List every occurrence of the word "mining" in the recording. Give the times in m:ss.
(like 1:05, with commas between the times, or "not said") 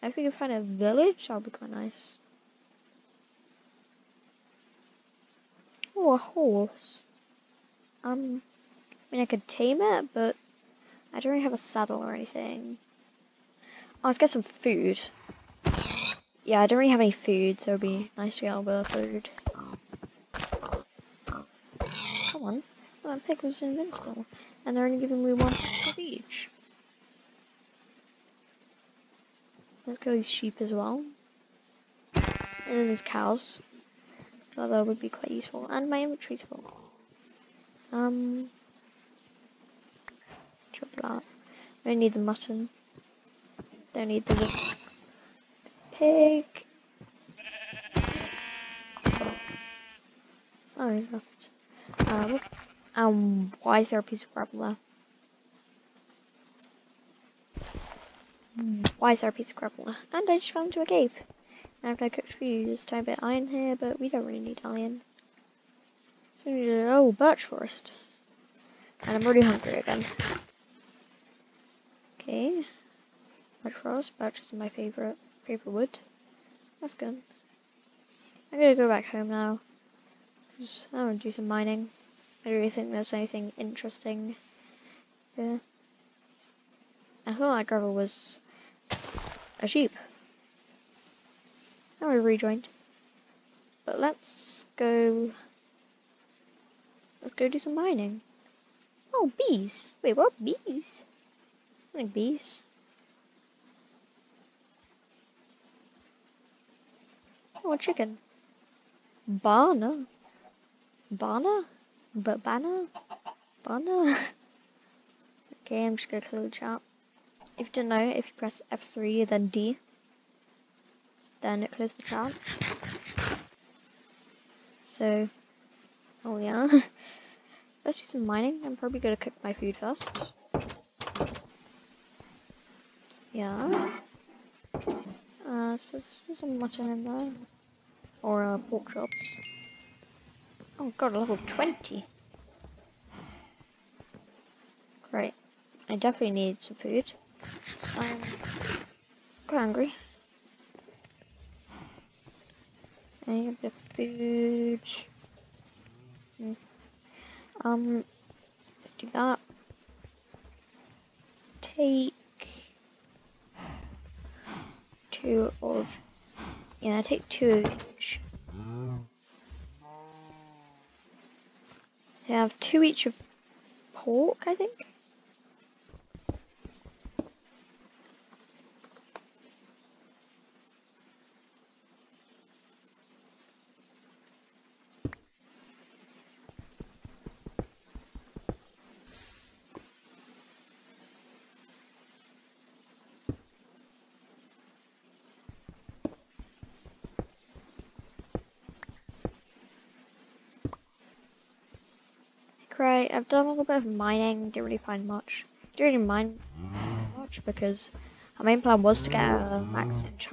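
1:21, 1:37, 2:08, 3:23.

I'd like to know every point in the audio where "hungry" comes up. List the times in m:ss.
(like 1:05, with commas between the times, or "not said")
1:09, 2:29.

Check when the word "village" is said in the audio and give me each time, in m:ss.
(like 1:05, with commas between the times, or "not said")
0:00.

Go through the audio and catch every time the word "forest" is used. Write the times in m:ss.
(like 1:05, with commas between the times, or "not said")
1:07, 1:13.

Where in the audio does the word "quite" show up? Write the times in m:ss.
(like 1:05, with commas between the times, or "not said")
0:01, 0:35, 2:29.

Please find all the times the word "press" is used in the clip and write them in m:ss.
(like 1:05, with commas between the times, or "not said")
1:58.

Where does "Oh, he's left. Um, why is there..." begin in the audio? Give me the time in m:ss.
0:50.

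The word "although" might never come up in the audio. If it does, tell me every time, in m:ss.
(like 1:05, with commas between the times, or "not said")
0:34.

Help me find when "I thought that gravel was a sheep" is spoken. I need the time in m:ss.
1:27.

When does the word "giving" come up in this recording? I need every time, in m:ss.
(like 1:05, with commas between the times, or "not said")
0:24.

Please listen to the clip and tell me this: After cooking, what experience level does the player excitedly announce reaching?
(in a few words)
20.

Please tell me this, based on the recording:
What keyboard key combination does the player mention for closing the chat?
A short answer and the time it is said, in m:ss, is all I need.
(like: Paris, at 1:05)
F3 then D, at 1:58.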